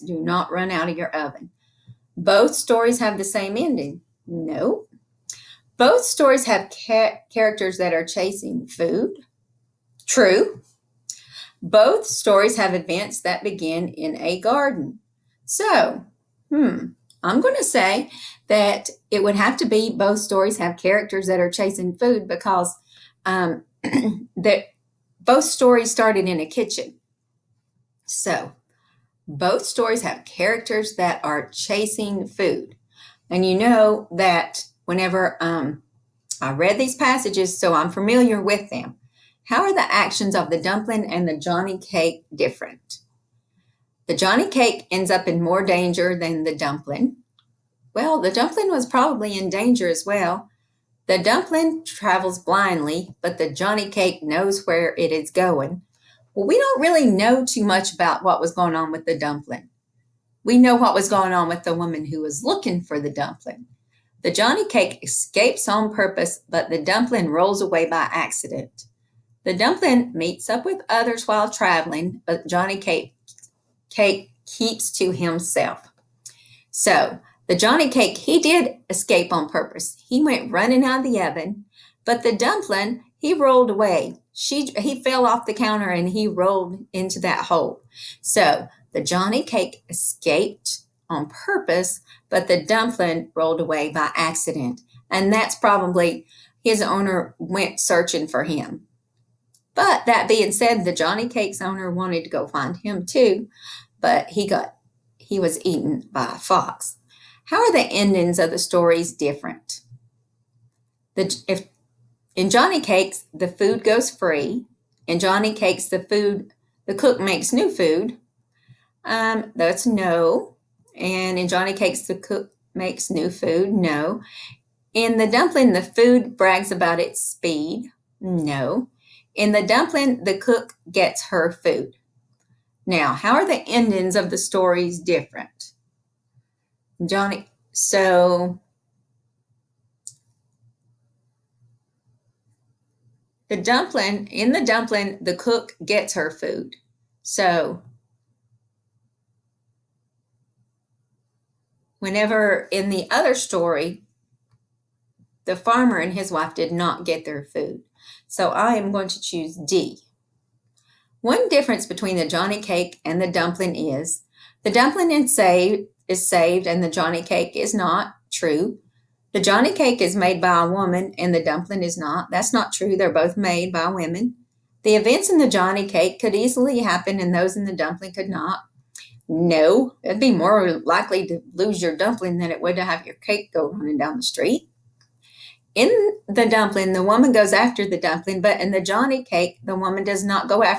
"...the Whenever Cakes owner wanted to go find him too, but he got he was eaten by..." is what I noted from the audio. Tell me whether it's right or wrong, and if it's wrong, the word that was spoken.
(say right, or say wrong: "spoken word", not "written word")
wrong: "Johnny", not "Whenever".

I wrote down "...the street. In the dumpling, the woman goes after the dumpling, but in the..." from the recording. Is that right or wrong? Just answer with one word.
right.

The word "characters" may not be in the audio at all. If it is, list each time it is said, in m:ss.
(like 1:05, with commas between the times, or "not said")
0:07, 0:20, 0:30.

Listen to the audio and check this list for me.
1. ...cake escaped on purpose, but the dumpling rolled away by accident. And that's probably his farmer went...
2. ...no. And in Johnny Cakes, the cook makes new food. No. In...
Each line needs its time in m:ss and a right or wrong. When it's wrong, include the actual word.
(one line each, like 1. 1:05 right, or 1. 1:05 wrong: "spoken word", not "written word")
1. 1:29 wrong: "owner", not "farmer"
2. 1:59 right.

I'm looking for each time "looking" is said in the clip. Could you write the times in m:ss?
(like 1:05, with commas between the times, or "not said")
1:02.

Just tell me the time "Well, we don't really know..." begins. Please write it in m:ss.
0:56.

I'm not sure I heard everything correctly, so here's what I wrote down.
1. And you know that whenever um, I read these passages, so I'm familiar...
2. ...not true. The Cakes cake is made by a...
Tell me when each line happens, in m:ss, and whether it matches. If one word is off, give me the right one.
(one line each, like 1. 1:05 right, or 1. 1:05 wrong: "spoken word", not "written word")
1. 0:33 right
2. 2:47 wrong: "Johnny", not "Cakes".